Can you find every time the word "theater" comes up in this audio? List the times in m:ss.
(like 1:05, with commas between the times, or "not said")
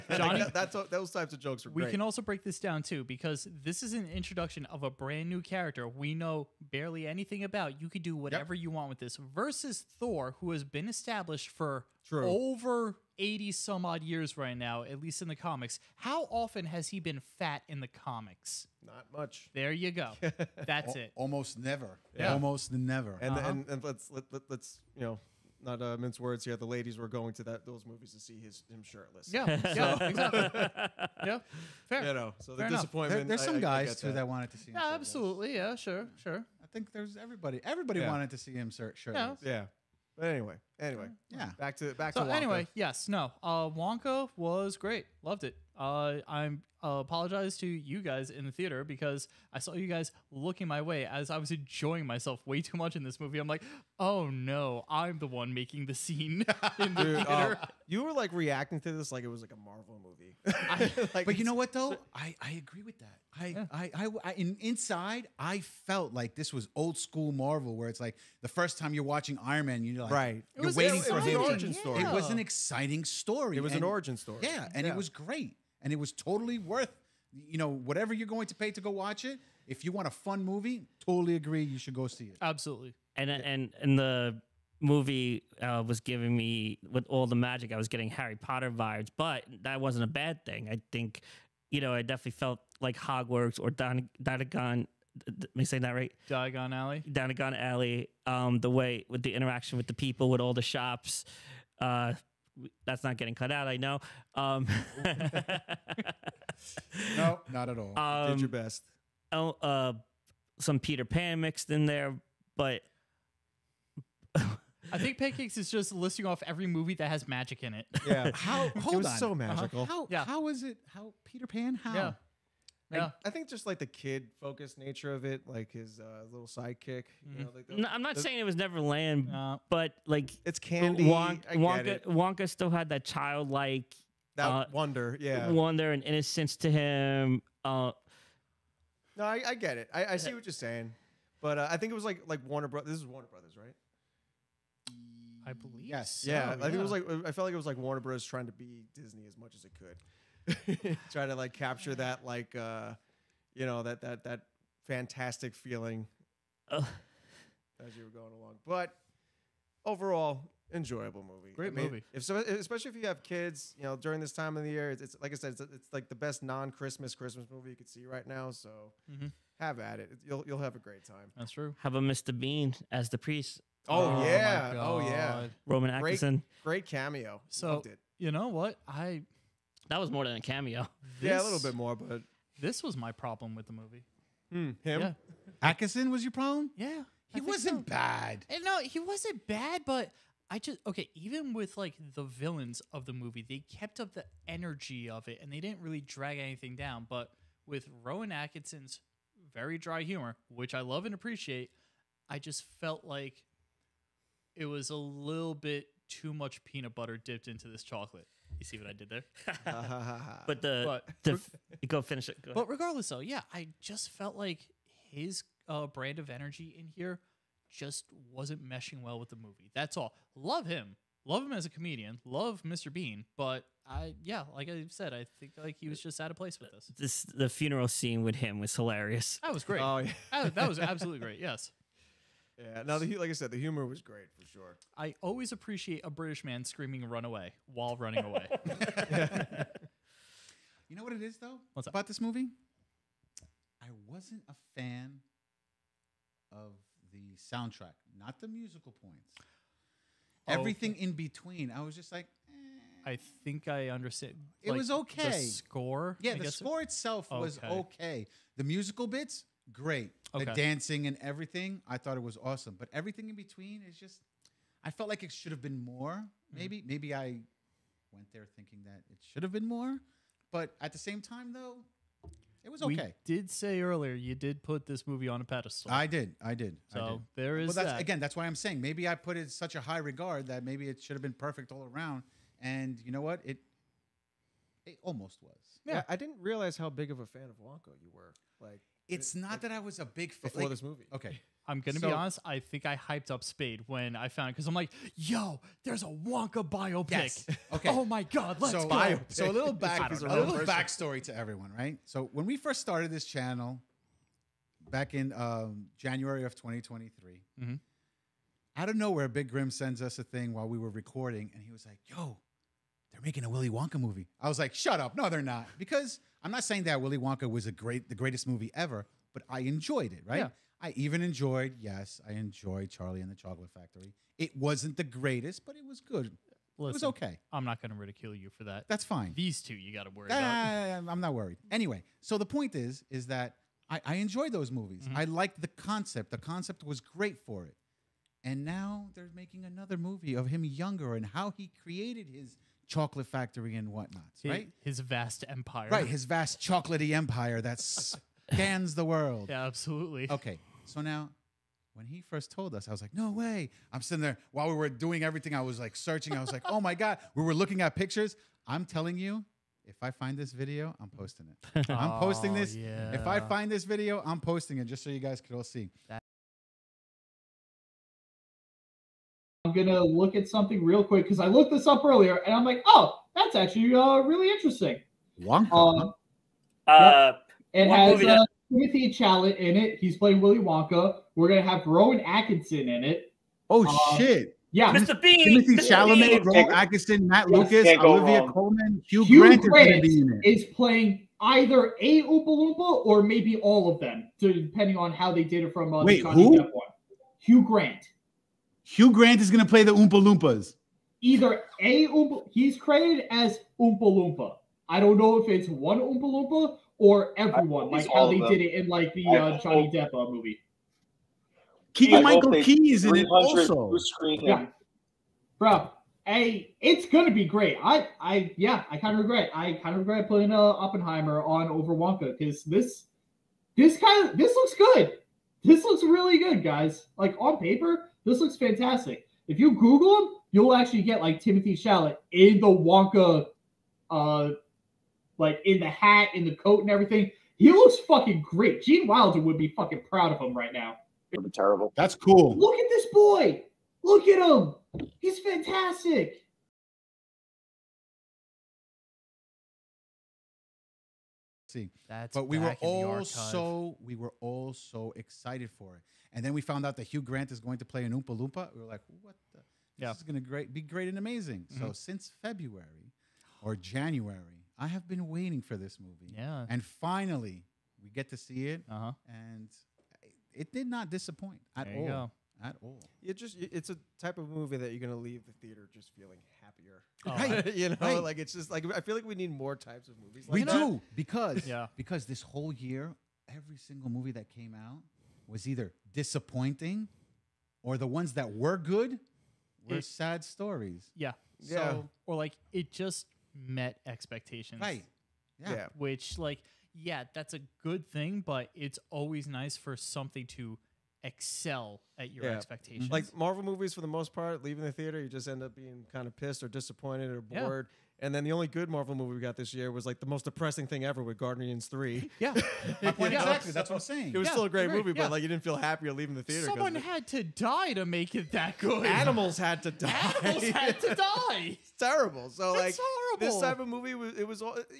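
0:48, 0:57, 7:55, 8:24, 8:36.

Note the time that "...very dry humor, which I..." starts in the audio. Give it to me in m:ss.
3:19.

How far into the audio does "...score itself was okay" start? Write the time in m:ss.
4:16.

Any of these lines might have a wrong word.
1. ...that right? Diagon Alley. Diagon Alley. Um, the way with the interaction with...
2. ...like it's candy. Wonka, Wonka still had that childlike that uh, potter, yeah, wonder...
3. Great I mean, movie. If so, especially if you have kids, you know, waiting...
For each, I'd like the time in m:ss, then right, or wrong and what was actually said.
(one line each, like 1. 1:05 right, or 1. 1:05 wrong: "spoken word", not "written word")
1. 1:35 right
2. 2:10 wrong: "wonder", not "potter"
3. 2:41 wrong: "during", not "waiting".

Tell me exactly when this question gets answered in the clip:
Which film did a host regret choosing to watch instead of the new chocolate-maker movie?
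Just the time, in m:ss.
7:00.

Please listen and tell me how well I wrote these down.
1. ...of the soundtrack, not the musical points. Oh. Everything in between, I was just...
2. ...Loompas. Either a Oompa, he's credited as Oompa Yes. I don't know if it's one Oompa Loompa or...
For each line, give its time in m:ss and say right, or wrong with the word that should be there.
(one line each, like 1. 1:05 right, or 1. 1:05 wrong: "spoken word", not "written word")
1. 4:06 right
2. 6:40 wrong: "Loompa", not "Yes".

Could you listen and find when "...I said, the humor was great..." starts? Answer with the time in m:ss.
3:53.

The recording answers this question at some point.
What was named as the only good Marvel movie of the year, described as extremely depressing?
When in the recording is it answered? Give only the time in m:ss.
8:31.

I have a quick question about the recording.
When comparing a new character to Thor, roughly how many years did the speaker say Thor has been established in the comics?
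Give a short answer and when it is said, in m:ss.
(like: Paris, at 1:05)
80, at 0:13.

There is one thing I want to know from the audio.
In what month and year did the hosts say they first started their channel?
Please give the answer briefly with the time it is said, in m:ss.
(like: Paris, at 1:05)
January 2023, at 5:05.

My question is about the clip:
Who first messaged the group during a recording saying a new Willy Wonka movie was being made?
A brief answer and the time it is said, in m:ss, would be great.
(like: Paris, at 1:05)
Big Grim, at 5:09.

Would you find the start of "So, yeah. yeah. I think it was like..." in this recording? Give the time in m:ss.
2:26.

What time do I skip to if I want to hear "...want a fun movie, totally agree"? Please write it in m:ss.
1:19.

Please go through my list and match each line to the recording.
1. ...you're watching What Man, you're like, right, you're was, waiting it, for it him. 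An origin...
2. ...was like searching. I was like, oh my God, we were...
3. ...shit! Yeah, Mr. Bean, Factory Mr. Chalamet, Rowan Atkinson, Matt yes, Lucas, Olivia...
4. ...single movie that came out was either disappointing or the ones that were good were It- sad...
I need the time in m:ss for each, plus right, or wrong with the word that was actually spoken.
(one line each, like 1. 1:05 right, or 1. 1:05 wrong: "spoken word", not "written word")
1. 1:08 wrong: "Iron", not "What"
2. 5:55 right
3. 6:24 wrong: "Timothy", not "Factory"
4. 8:03 right.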